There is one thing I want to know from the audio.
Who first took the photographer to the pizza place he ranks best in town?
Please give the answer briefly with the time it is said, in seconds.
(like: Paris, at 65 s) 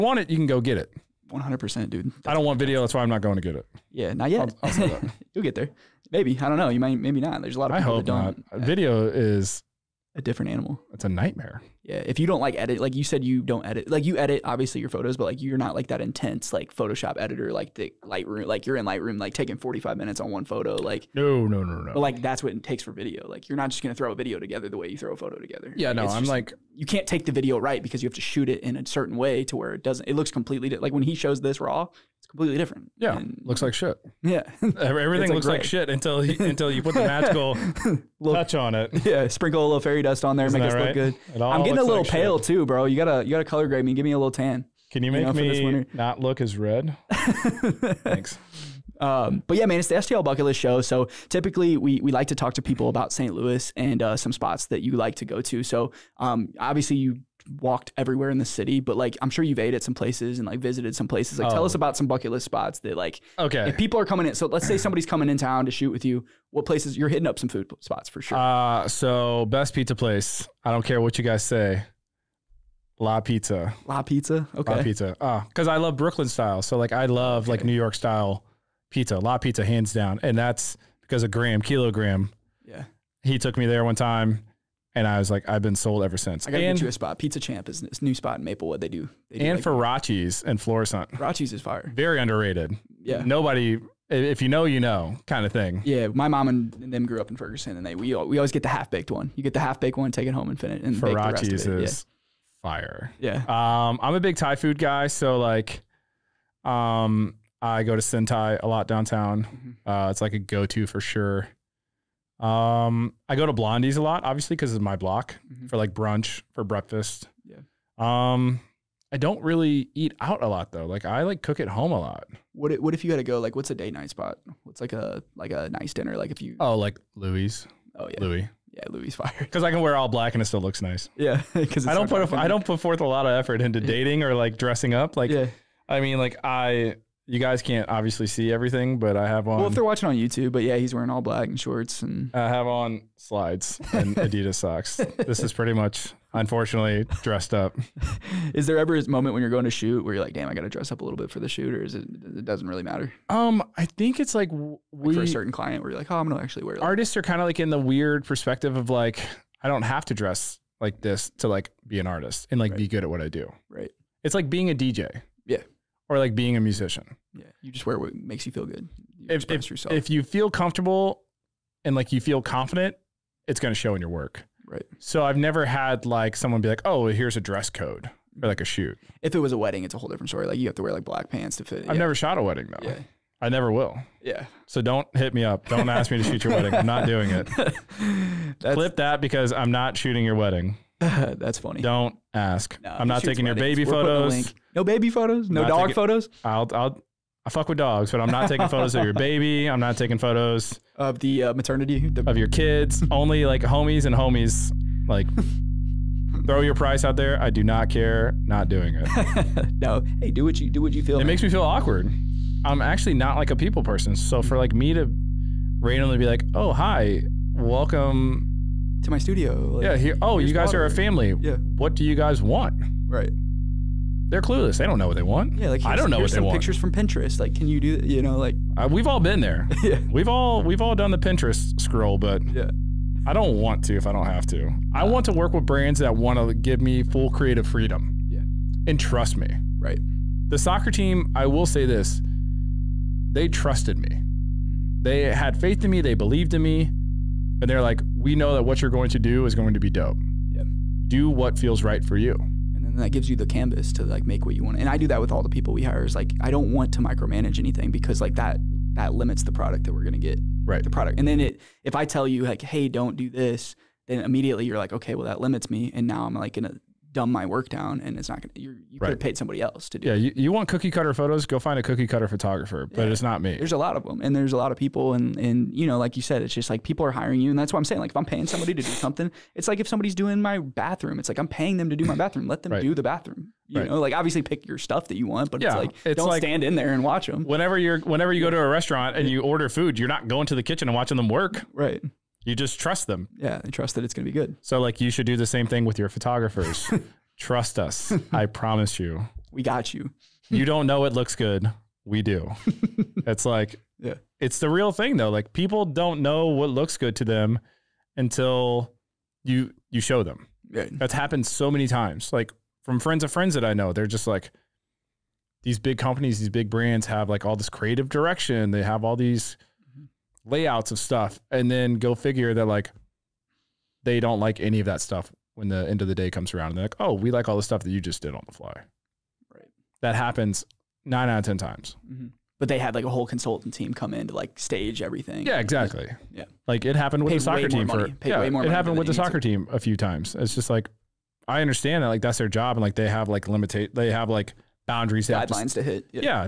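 Graham Kilogram, at 81 s.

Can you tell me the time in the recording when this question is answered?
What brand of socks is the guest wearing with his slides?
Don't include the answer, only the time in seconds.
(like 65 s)
144 s.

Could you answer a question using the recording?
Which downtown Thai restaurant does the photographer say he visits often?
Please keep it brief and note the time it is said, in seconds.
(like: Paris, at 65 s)
Sen Thai, at 108 s.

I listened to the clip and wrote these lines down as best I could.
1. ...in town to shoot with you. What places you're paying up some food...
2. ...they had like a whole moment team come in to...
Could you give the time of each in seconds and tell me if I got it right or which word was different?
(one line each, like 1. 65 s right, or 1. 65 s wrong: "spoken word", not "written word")
1. 65 s wrong: "hitting", not "paying"
2. 332 s wrong: "consultant", not "moment".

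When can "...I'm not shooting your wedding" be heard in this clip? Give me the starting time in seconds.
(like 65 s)
189 s.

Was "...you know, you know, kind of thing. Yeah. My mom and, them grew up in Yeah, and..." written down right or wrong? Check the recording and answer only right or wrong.
wrong.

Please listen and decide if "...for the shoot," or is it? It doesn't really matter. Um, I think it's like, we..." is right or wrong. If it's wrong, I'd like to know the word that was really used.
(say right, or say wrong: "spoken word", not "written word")
right.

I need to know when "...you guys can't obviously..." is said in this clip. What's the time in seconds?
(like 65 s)
137 s.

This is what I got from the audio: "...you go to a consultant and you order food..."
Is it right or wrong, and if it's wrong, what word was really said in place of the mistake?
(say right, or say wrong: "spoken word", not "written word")
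wrong: "restaurant", not "consultant".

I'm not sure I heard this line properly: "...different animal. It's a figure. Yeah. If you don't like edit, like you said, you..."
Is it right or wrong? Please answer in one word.
wrong.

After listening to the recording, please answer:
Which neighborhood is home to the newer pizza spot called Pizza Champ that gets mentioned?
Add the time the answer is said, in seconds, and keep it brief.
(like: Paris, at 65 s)
Maplewood, at 88 s.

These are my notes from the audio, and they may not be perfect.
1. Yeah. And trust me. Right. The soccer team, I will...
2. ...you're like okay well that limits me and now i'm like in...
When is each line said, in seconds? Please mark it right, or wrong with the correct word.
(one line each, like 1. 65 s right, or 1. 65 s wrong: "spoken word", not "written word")
1. 238 s right
2. 264 s right.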